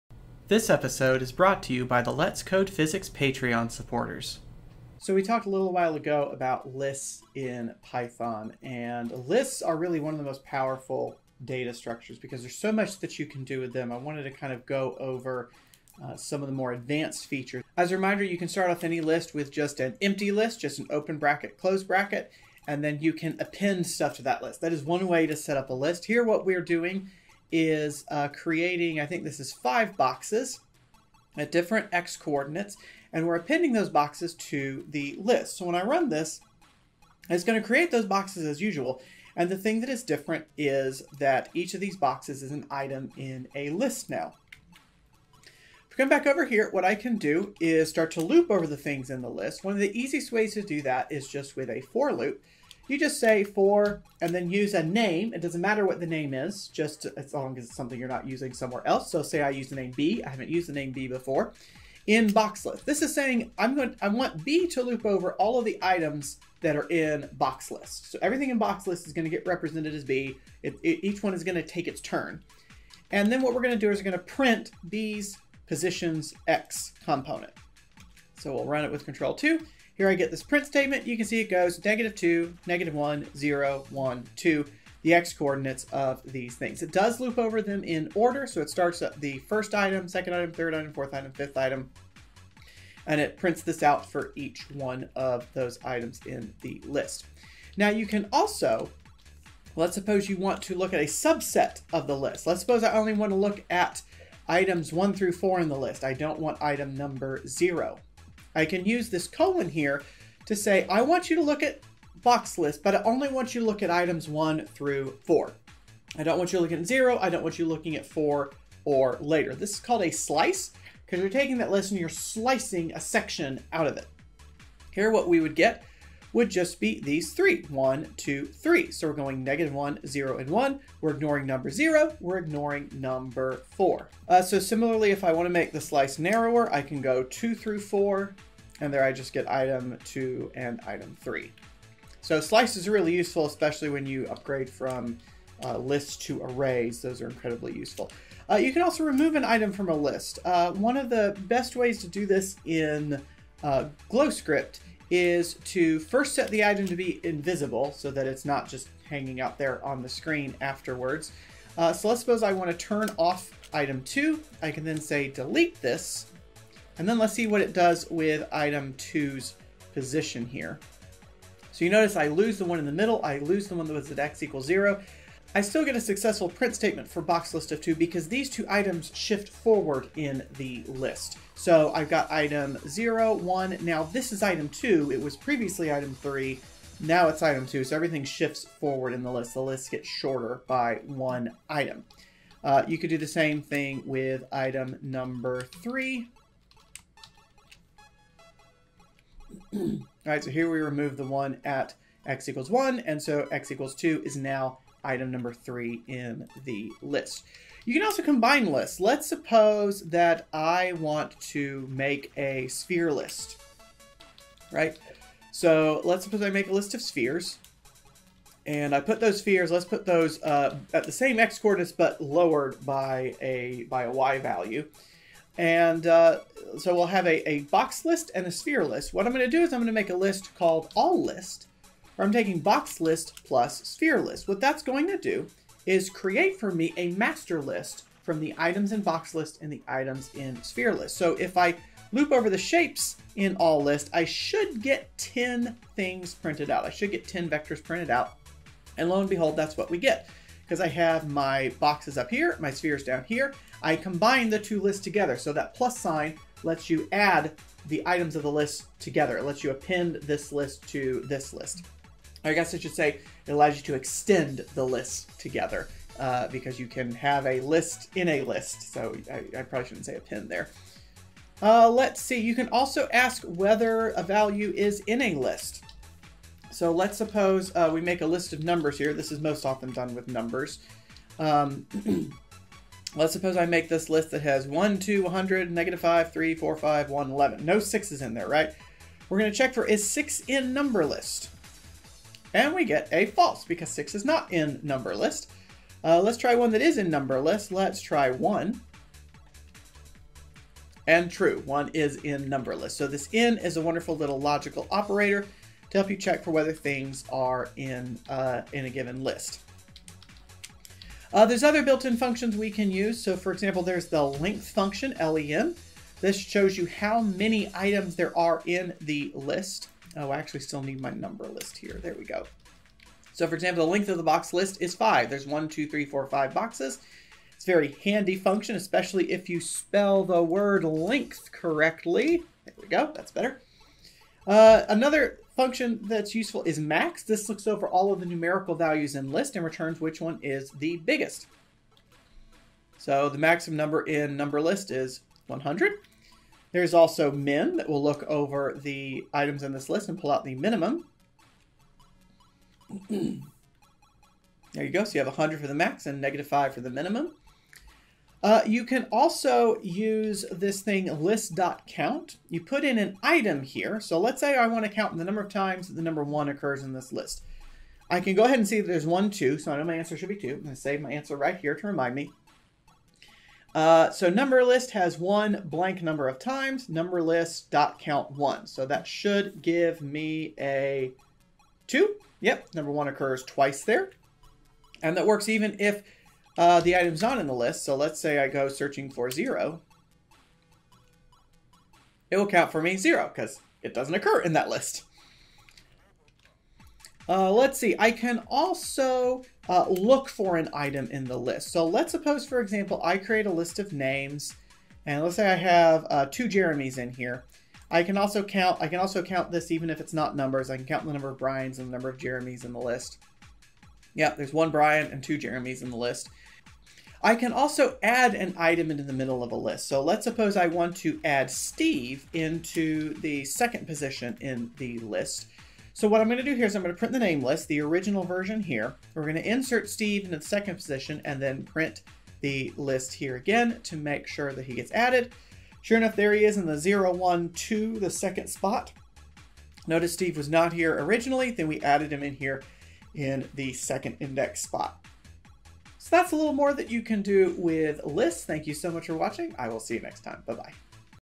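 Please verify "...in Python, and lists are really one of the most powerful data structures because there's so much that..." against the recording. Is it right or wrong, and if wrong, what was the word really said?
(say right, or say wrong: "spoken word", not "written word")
right.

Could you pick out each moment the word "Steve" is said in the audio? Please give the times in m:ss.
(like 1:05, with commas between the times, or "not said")
7:01, 7:09, 7:20.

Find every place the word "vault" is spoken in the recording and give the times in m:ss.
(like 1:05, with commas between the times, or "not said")
not said.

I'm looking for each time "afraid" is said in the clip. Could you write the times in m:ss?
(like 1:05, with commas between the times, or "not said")
not said.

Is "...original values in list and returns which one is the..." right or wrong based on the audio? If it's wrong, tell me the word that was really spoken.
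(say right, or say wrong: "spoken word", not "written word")
wrong: "numerical", not "original".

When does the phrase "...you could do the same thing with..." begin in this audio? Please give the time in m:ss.
3:12.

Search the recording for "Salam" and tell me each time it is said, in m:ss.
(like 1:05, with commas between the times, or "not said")
not said.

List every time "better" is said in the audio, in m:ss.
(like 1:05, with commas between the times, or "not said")
5:33.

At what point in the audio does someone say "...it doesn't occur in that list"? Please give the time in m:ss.
6:33.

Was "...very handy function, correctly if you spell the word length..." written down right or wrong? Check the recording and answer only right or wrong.
wrong.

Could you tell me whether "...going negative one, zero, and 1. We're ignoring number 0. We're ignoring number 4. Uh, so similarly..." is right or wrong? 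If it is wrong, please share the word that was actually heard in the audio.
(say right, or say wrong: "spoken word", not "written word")
right.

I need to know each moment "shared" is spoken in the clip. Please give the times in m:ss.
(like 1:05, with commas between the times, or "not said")
not said.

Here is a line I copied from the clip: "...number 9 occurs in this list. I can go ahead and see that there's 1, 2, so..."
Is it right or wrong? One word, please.
wrong.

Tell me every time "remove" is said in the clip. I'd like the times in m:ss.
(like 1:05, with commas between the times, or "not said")
2:29, 3:20.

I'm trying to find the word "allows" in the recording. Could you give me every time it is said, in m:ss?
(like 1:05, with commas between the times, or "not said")
4:23.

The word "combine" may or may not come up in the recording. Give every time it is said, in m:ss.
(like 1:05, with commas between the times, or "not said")
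3:28, 4:13.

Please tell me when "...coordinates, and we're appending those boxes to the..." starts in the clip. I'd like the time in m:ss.
0:32.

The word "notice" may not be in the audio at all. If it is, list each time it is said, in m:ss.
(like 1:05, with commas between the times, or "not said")
2:51, 7:19.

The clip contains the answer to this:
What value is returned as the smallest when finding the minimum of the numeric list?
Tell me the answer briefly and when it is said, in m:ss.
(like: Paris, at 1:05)
-5, at 5:56.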